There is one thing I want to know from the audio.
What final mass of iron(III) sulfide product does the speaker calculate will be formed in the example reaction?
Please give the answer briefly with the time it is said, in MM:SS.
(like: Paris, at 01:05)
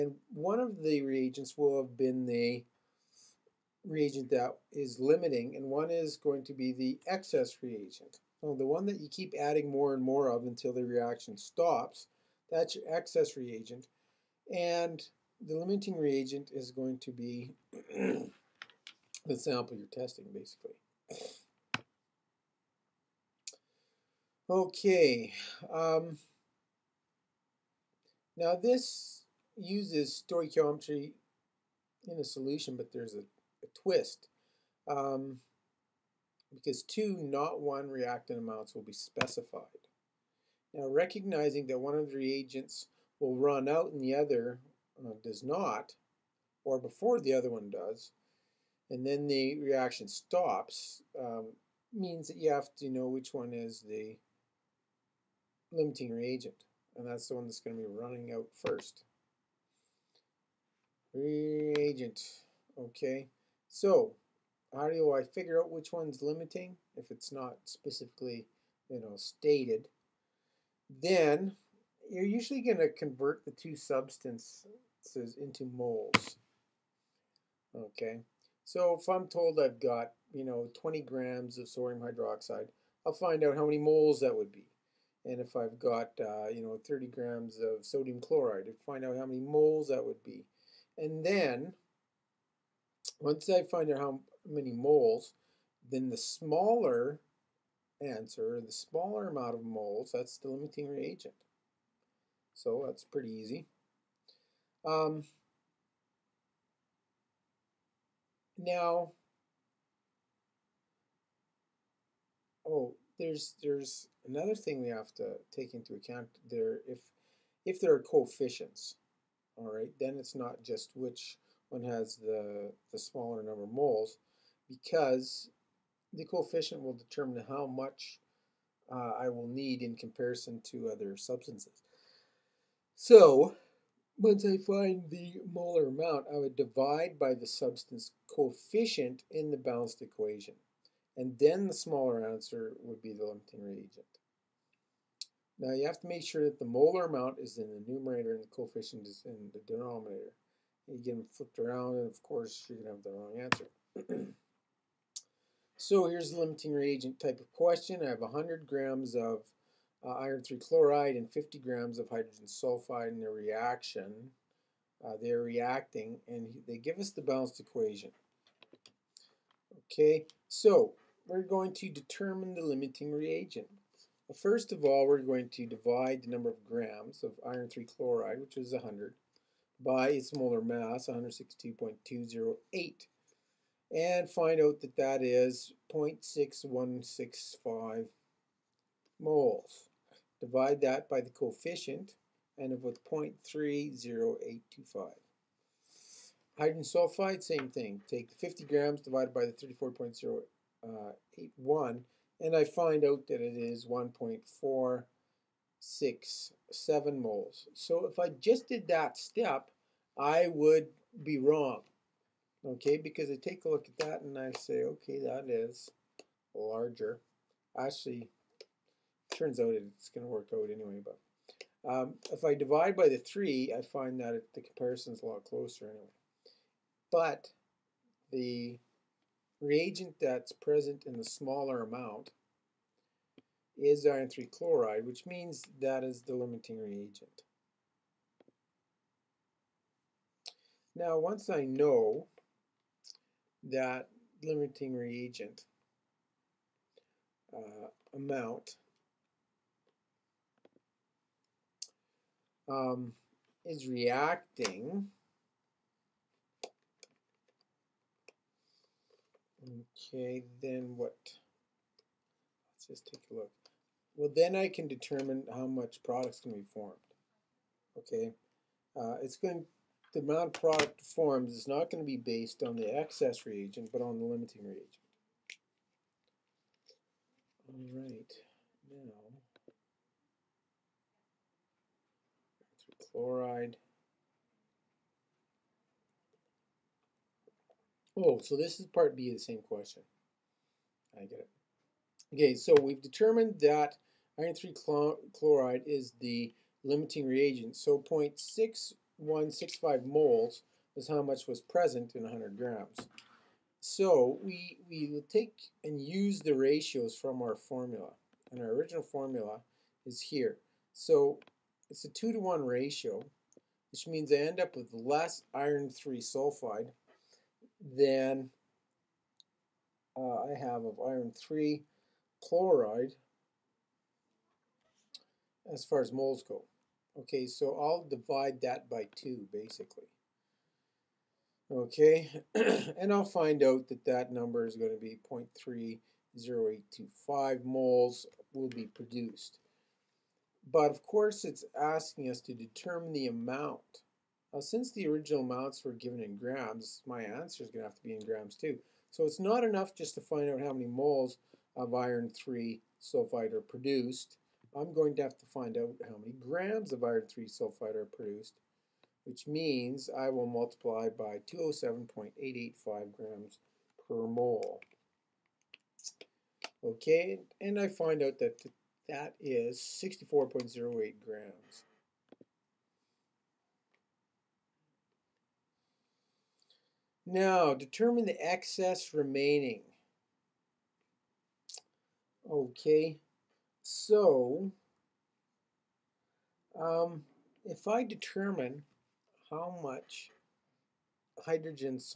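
64.08 grams, at 06:09.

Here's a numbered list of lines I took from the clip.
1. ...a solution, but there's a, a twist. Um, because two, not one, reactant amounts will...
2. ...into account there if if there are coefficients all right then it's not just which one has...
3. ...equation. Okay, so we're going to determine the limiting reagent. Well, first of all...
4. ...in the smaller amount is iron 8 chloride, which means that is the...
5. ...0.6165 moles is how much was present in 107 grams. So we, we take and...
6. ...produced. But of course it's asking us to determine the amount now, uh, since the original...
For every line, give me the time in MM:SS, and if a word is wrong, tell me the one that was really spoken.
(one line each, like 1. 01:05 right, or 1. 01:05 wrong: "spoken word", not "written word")
1. 00:32 right
2. 01:55 right
3. 02:47 right
4. 03:51 wrong: "3", not "8"
5. 04:58 wrong: "100", not "107"
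6. 05:38 right.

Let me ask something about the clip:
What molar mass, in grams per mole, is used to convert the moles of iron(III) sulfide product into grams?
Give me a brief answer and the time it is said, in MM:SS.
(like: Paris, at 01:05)
207.885, at 06:01.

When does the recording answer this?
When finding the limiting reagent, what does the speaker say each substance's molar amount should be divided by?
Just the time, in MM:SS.
02:17.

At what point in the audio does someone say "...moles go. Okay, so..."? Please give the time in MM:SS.
05:26.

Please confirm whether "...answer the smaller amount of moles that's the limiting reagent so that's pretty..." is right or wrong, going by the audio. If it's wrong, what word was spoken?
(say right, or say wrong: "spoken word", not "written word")
right.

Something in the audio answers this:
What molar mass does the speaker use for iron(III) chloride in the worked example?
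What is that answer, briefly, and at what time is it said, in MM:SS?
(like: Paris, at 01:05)
162.208, at 03:01.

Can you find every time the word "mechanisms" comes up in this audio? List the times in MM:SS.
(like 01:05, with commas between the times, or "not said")
not said.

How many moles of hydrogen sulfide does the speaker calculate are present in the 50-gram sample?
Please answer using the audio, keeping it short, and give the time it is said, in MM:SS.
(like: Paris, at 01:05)
1.467 moles, at 03:23.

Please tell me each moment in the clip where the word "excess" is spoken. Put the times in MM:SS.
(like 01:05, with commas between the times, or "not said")
00:07, 00:12, 04:32, 06:18.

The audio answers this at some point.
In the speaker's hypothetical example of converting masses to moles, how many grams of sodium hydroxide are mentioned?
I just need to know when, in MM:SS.
01:20.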